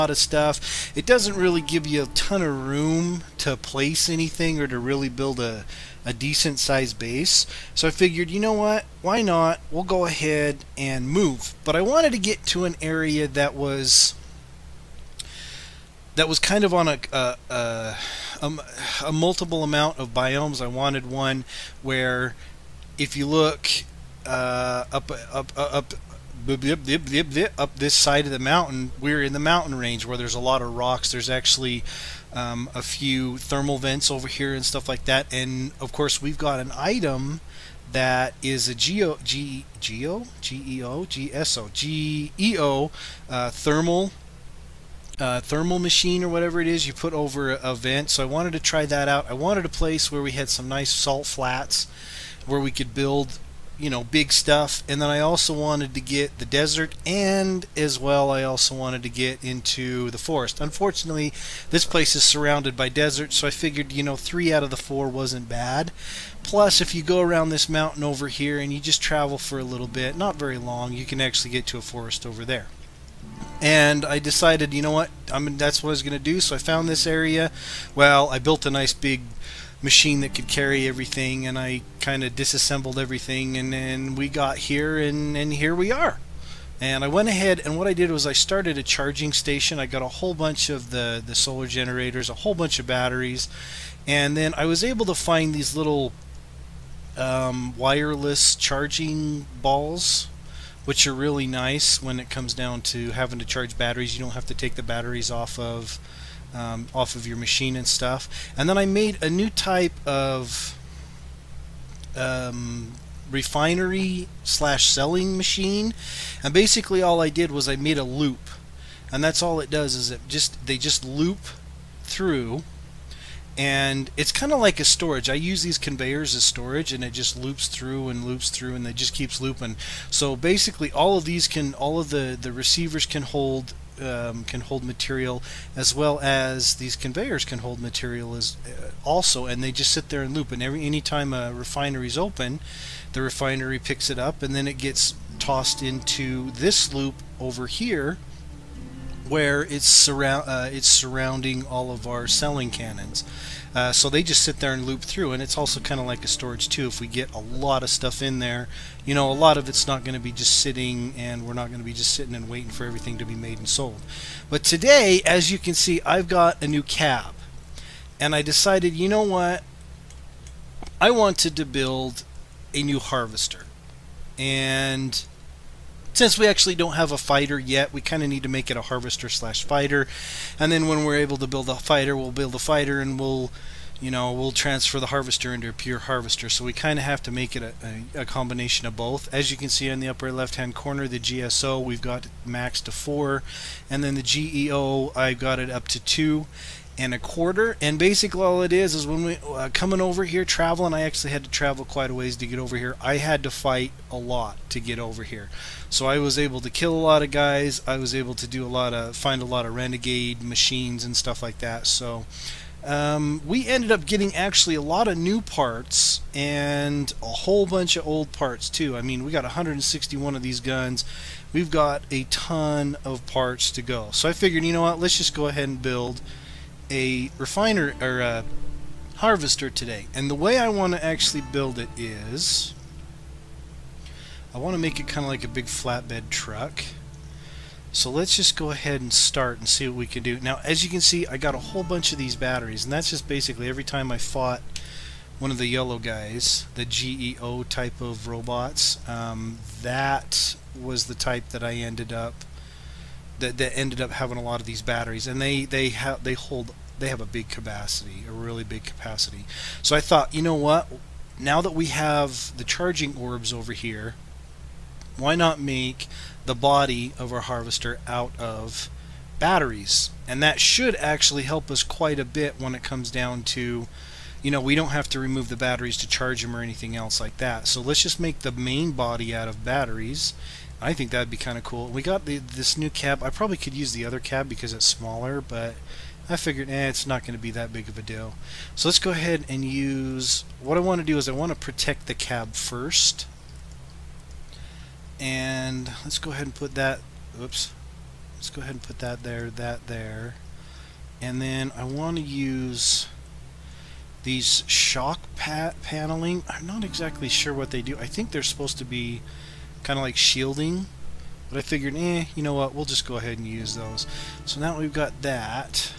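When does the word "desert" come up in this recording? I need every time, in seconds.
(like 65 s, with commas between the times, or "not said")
56 s, 62 s.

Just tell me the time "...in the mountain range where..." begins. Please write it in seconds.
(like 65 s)
29 s.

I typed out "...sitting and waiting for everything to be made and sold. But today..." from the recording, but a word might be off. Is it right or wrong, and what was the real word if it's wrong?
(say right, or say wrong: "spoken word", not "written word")
right.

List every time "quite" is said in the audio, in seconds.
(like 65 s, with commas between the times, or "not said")
201 s, 271 s.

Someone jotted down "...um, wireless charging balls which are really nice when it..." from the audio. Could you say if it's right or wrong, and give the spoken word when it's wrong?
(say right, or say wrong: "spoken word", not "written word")
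right.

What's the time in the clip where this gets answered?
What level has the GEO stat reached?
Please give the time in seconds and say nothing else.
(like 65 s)
195 s.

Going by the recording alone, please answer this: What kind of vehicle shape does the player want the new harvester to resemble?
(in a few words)
flatbed truck.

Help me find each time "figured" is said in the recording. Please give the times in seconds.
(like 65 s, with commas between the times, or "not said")
7 s, 63 s, 224 s, 286 s, 311 s.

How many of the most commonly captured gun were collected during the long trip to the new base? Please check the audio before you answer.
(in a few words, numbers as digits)
161.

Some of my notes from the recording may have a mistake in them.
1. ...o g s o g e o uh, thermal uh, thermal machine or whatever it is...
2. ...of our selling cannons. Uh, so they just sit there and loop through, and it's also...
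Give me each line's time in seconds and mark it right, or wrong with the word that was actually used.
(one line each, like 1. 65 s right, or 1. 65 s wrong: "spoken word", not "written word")
1. 40 s right
2. 151 s right.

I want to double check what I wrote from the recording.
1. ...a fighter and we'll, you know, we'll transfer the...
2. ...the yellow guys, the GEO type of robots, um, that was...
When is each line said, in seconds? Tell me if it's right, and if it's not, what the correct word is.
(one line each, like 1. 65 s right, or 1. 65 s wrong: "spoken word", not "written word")
1. 182 s right
2. 245 s right.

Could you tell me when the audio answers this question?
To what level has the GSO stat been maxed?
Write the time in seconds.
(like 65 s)
192 s.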